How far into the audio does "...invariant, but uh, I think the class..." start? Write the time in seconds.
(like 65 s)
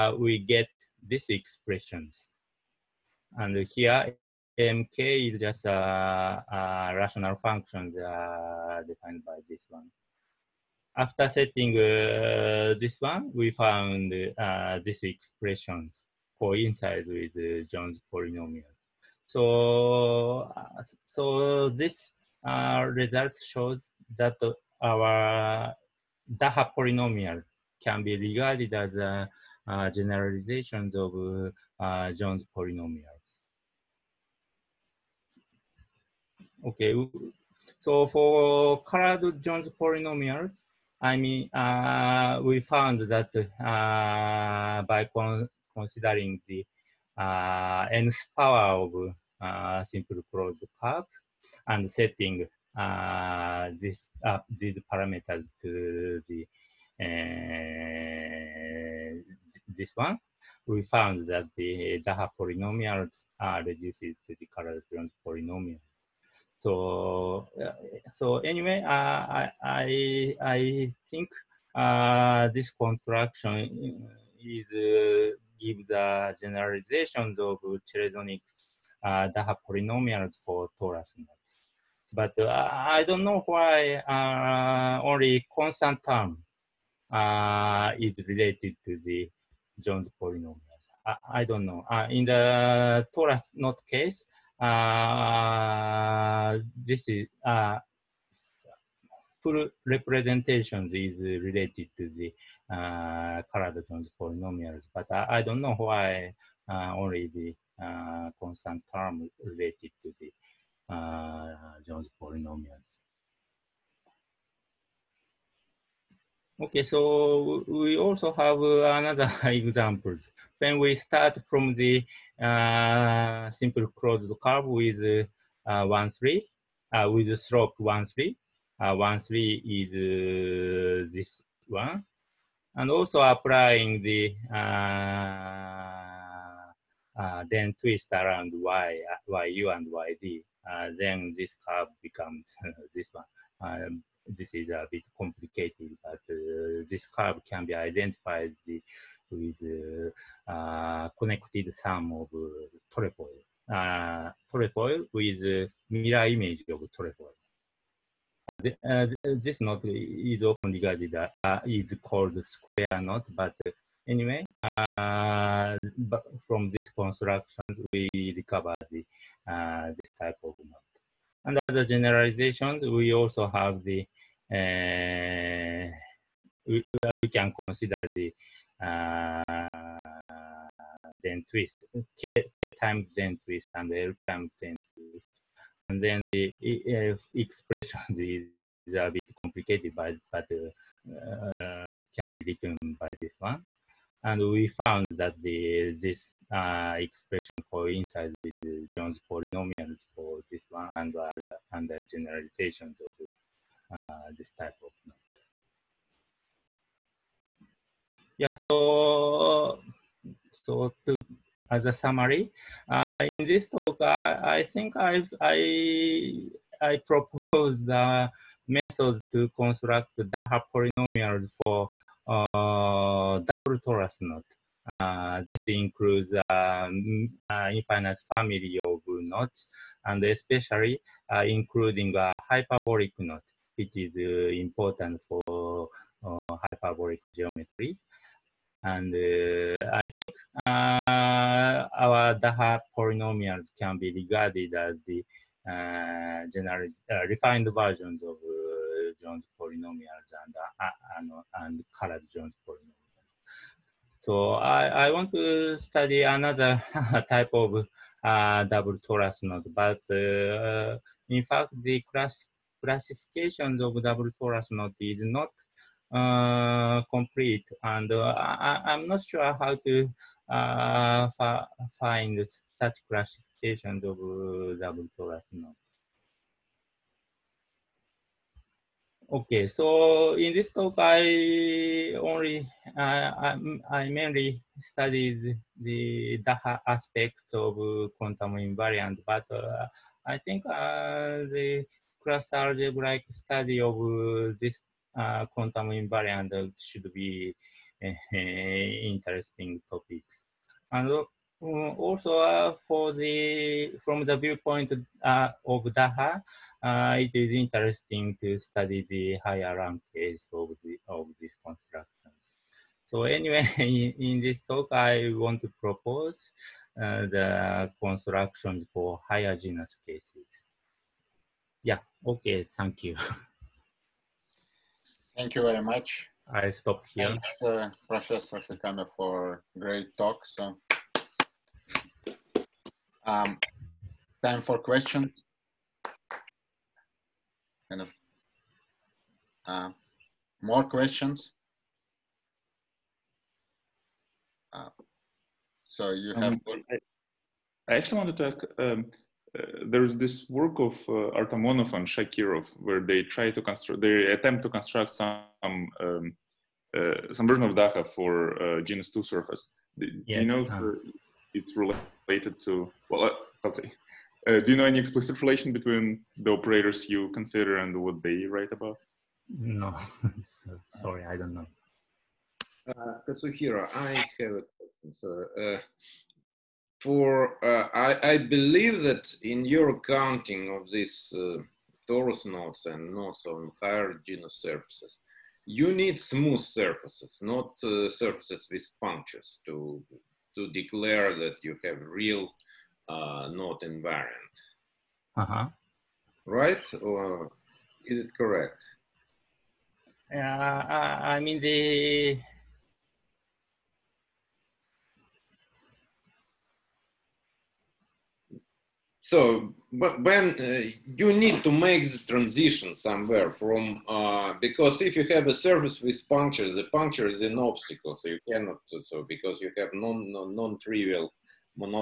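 288 s.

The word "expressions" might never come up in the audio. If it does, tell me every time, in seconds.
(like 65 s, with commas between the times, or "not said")
1 s, 15 s, 187 s, 196 s.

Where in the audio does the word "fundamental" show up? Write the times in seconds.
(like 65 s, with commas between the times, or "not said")
not said.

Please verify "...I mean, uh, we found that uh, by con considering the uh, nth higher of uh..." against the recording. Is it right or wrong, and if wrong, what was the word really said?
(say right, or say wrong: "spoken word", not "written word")
wrong: "power", not "higher".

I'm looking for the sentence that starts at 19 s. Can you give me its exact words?
So, uh, so this uh, result shows that our Daha polynomial can be regarded as a, a generalizations of uh, Jones polynomials.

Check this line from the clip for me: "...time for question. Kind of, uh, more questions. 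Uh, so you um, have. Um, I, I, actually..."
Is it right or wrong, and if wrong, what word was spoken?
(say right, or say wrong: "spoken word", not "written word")
right.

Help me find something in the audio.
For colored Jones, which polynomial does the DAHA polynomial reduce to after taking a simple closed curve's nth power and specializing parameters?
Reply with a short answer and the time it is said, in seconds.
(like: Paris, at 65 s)
carl polynomial, at 64 s.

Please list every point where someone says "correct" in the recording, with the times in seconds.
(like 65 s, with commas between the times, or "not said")
398 s.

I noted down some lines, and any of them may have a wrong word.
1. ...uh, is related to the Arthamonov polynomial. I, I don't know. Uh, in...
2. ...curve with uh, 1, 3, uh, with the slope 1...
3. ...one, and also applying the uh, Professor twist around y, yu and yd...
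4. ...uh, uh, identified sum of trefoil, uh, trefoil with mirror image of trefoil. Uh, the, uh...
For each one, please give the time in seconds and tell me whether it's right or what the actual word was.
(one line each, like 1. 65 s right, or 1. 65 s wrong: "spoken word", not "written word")
1. 87 s wrong: "Jones", not "Arthamonov"
2. 124 s right
3. 131 s wrong: "Dehn", not "Professor"
4. 150 s wrong: "connected", not "identified".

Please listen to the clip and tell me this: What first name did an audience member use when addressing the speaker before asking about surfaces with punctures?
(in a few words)
Kazuhiro.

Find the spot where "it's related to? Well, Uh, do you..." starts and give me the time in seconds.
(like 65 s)
361 s.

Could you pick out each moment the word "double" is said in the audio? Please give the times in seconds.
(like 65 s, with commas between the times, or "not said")
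223 s, 258 s, 264 s, 274 s.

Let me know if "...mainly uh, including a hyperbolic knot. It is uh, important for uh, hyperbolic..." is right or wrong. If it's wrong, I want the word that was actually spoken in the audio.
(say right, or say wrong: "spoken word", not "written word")
wrong: "especially", not "mainly".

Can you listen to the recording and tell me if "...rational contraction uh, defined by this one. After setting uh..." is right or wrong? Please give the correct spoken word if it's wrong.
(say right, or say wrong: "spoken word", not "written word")
wrong: "function", not "contraction".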